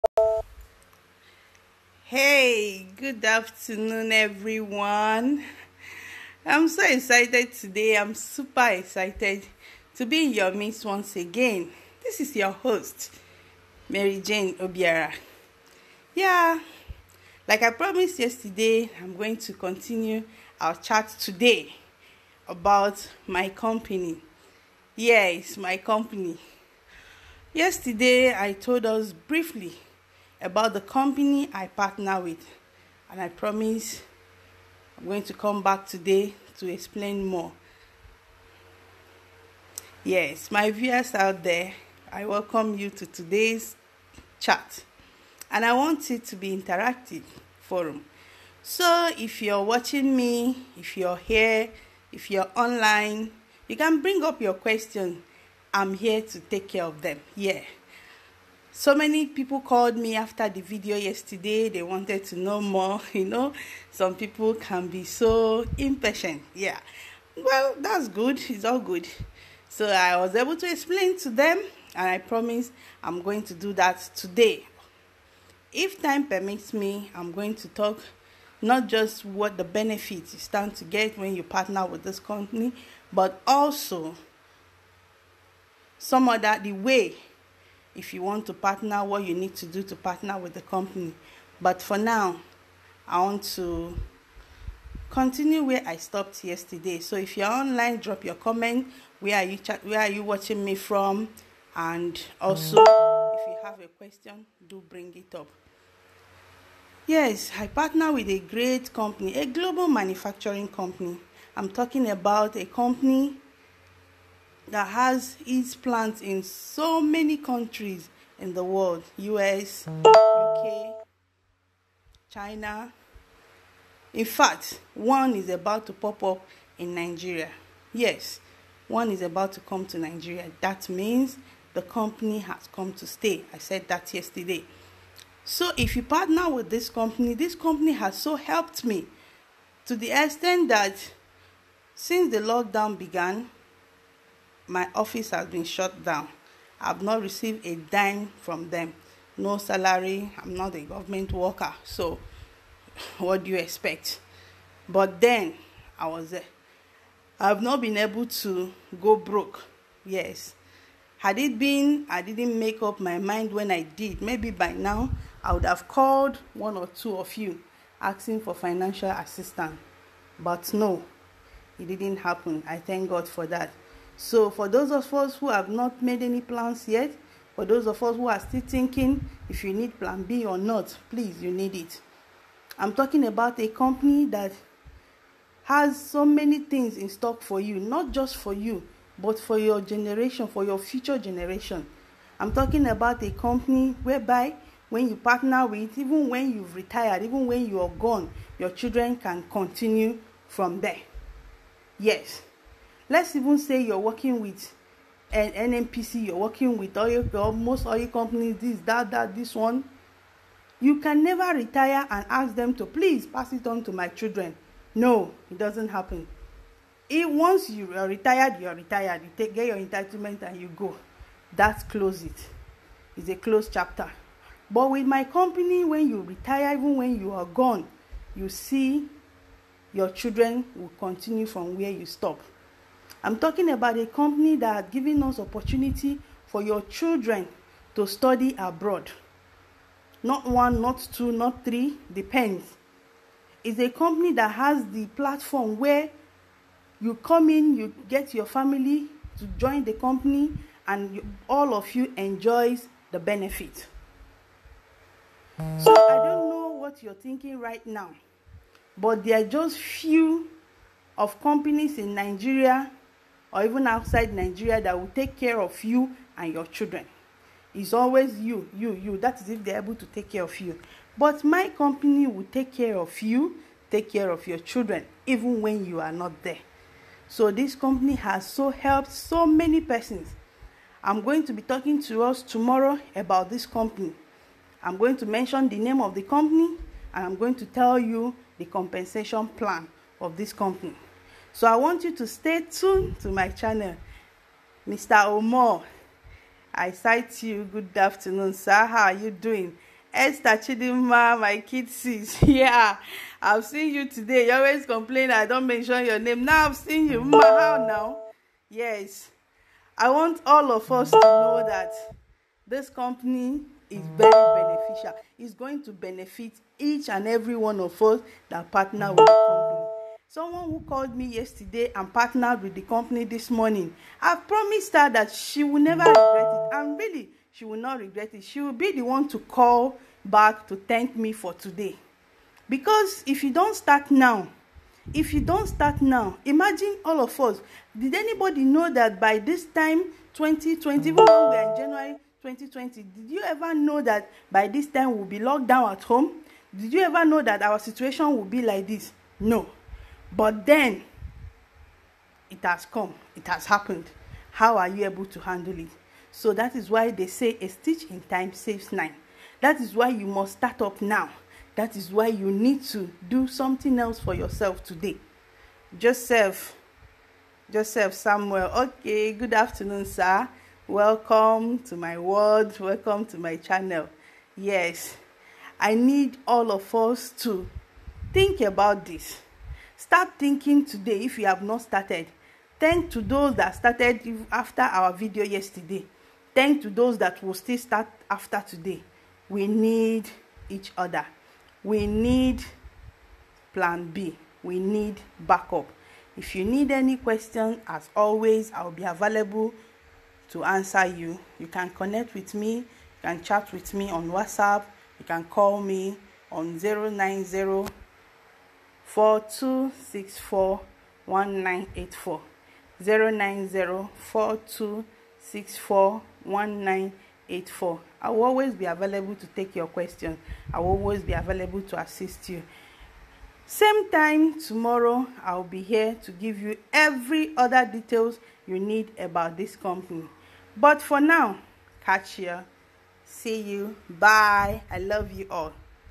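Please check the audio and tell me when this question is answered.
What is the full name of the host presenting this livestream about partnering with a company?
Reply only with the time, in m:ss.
0:13.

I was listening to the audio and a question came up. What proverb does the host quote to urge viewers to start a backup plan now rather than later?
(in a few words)
A stitch in time saves nine.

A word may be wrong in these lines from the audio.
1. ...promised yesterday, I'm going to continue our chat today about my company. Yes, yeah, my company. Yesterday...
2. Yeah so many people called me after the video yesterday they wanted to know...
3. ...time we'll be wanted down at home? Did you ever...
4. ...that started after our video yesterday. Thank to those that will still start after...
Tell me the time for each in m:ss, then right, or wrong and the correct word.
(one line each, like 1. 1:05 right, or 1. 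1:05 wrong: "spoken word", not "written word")
1. 0:17 right
2. 0:57 right
3. 5:44 wrong: "locked", not "wanted"
4. 6:23 right.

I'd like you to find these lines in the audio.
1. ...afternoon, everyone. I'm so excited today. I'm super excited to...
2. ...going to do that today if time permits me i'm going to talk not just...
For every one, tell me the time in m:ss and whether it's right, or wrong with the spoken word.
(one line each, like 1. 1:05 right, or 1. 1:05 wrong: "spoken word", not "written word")
1. 0:03 right
2. 1:13 right.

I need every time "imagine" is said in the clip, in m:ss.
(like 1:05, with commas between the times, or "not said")
5:36.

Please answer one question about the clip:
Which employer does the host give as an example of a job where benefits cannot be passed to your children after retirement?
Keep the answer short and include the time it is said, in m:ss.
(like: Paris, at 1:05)
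NNPC, at 3:25.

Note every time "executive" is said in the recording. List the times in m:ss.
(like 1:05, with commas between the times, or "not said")
not said.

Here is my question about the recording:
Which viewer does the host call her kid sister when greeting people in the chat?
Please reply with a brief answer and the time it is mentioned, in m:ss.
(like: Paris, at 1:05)
Esther Chidinma, at 5:00.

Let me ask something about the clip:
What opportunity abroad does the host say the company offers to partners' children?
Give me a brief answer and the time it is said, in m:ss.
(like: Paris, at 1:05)
Study abroad, at 3:58.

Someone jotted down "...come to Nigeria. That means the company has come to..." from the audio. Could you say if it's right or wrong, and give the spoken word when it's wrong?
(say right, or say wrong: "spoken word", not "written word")
right.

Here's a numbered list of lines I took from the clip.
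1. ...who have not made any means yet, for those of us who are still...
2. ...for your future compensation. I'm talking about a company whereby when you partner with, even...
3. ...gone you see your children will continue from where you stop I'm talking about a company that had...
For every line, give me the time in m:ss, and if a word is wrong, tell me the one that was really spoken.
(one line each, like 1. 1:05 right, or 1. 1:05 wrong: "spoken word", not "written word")
1. 2:55 wrong: "plans", not "means"
2. 3:10 wrong: "generation", not "compensation"
3. 3:47 right.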